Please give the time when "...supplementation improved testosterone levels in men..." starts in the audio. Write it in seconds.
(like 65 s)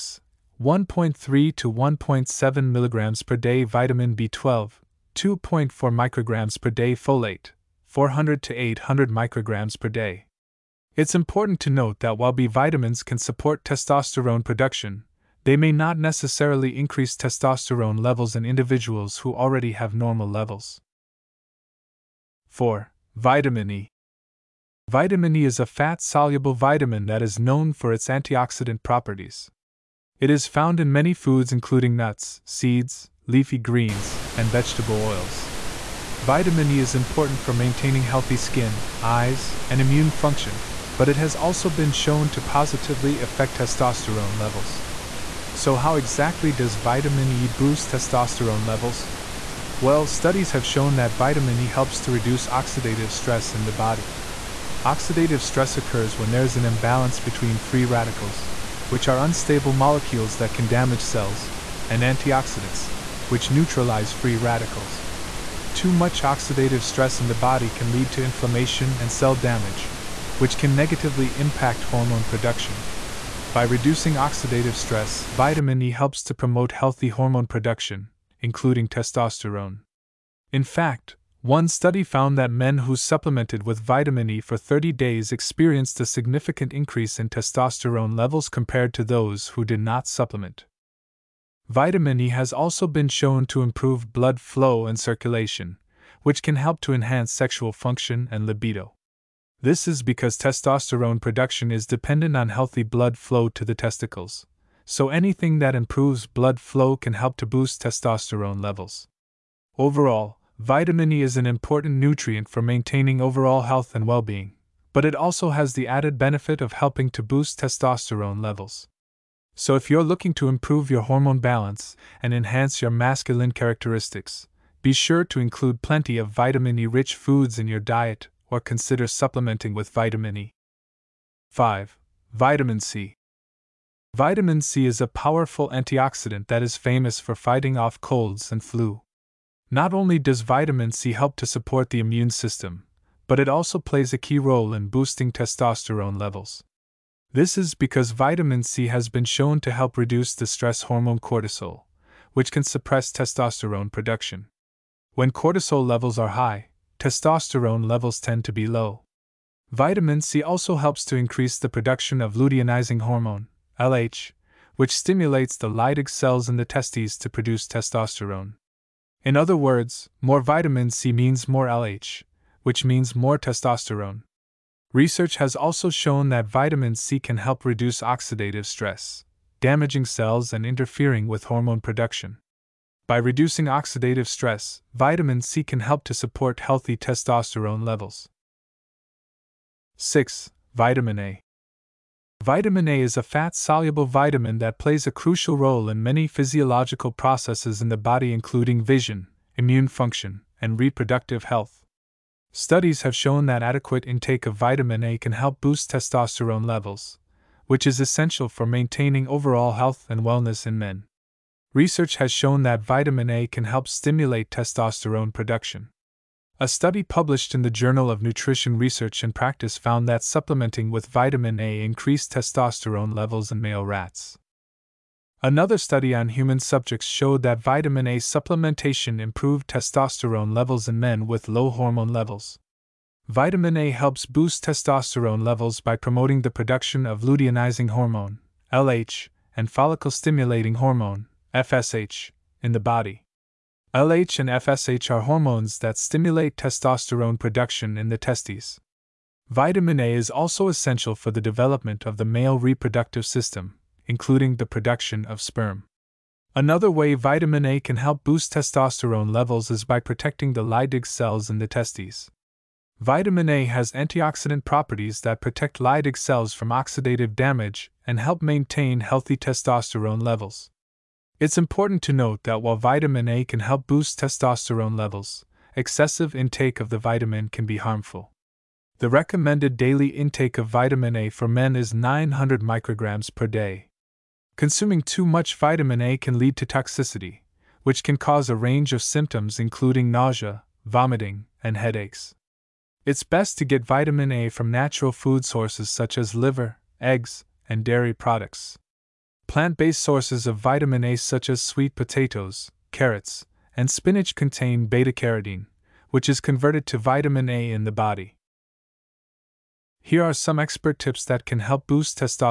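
228 s.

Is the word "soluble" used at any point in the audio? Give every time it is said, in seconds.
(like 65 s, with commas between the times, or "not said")
26 s, 193 s.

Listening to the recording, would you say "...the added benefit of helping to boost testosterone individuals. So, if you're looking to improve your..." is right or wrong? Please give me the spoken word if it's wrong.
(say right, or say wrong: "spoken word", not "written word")
wrong: "levels", not "individuals".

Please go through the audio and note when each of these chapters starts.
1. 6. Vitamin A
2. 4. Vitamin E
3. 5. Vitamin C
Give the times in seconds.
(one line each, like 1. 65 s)
1. 189 s
2. 22 s
3. 131 s.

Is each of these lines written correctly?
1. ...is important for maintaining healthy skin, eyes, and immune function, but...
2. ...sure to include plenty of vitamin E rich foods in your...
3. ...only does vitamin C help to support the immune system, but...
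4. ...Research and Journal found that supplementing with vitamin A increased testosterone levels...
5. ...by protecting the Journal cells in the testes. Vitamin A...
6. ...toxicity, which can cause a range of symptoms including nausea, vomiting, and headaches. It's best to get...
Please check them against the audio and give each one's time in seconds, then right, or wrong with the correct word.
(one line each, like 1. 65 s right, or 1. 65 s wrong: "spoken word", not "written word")
1. 36 s right
2. 124 s right
3. 139 s right
4. 218 s wrong: "Practice", not "Journal"
5. 259 s wrong: "Leydig", not "Journal"
6. 286 s right.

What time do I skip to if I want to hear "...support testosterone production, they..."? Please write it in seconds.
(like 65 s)
13 s.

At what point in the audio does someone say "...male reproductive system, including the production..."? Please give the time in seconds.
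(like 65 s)
252 s.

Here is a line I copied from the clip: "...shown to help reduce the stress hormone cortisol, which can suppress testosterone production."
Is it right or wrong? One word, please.
right.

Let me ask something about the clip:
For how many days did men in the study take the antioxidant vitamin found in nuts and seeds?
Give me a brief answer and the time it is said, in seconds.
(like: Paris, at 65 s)
30, at 84 s.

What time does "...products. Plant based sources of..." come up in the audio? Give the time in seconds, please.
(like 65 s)
298 s.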